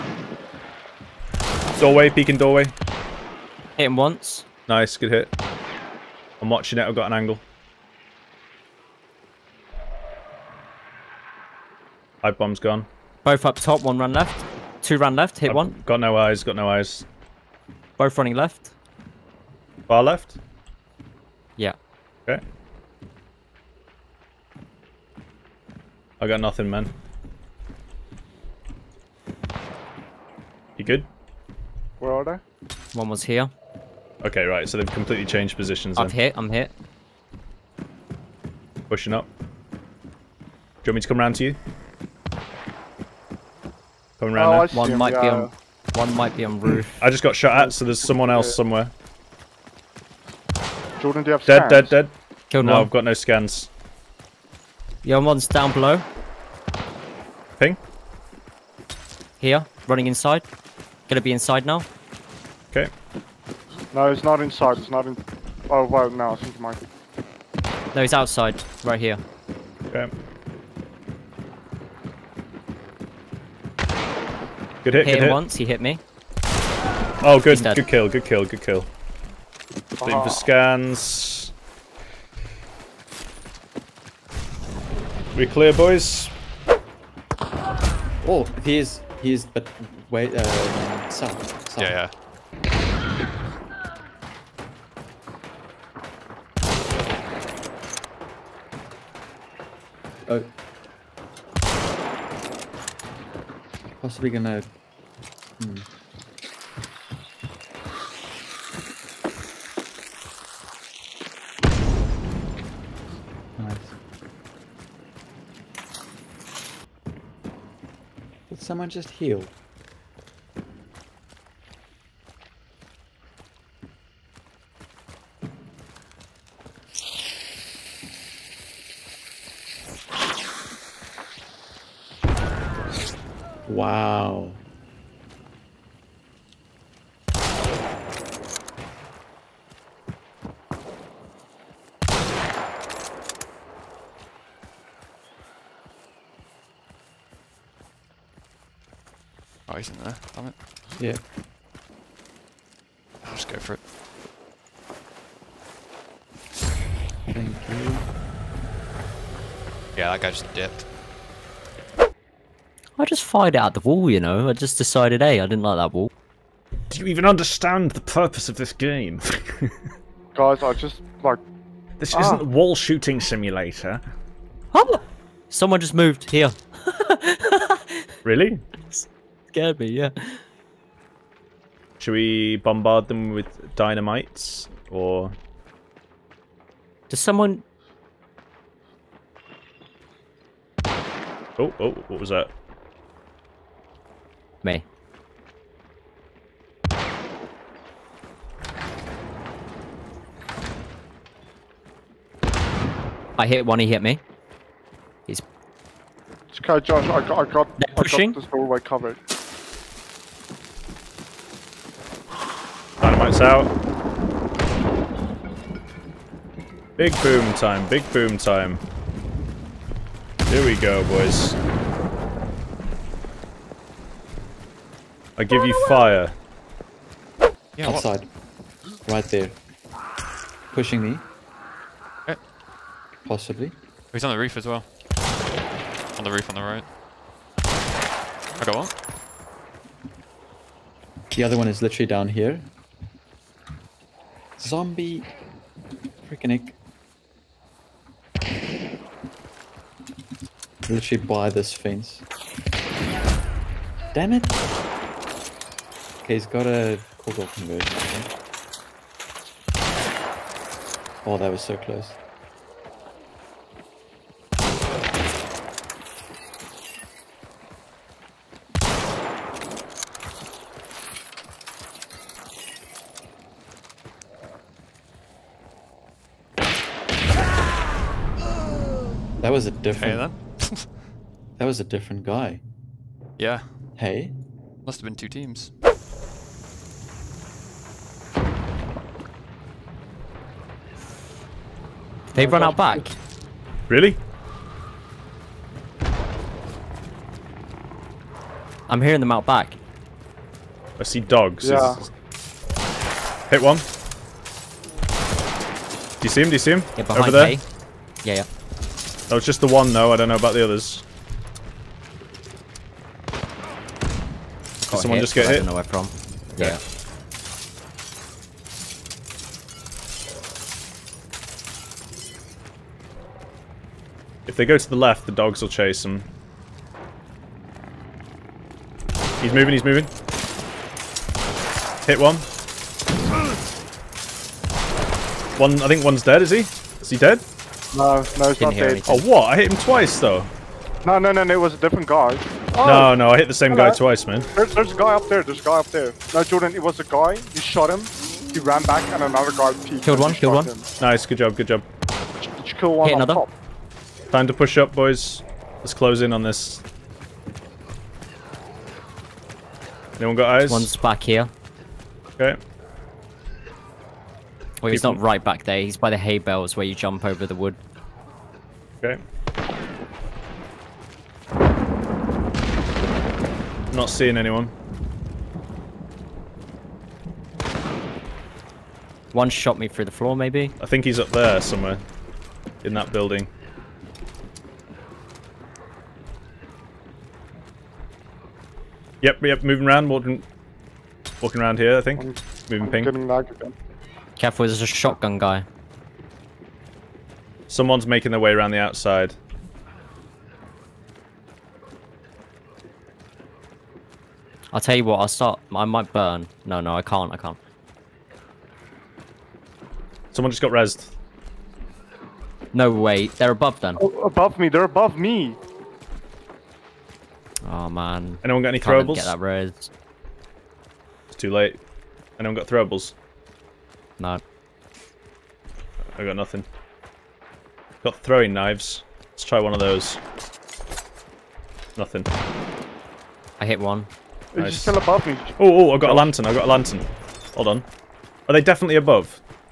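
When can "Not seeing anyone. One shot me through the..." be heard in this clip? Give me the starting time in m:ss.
6:13.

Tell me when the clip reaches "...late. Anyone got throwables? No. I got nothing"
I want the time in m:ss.
7:01.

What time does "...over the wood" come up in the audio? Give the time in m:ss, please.
6:07.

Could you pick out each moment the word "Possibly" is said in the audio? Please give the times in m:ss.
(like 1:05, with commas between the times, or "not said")
1:44, 3:53.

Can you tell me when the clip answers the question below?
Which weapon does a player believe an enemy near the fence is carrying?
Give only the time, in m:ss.
4:17.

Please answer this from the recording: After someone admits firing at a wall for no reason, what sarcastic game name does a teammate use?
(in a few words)
Wall shooting simulator.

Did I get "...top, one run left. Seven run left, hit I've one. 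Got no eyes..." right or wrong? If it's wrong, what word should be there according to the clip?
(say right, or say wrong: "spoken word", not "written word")
wrong: "Two", not "Seven".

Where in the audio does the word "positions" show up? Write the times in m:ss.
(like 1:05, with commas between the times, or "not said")
0:35.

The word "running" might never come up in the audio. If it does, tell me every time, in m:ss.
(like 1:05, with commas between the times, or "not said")
0:18, 0:59.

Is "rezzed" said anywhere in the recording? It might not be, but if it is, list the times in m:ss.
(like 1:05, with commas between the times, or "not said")
6:50.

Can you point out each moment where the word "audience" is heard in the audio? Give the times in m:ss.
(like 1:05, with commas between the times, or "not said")
not said.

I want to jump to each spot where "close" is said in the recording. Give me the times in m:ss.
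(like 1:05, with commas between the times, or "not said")
4:21, 5:55.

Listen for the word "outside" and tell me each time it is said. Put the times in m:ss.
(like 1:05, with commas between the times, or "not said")
1:08, 3:47, 6:38.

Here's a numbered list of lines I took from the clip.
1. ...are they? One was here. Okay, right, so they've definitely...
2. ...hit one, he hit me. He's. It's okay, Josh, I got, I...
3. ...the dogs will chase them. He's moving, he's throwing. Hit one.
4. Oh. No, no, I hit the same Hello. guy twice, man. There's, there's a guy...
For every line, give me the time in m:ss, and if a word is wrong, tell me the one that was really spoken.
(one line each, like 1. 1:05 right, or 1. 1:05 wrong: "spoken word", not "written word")
1. 0:32 wrong: "completely", not "definitely"
2. 3:23 right
3. 5:25 wrong: "moving", not "throwing"
4. 5:42 right.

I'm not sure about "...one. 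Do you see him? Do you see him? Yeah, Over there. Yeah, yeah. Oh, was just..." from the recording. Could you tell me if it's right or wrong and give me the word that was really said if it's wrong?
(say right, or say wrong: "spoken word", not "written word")
right.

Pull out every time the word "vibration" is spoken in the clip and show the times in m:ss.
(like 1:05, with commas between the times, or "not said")
not said.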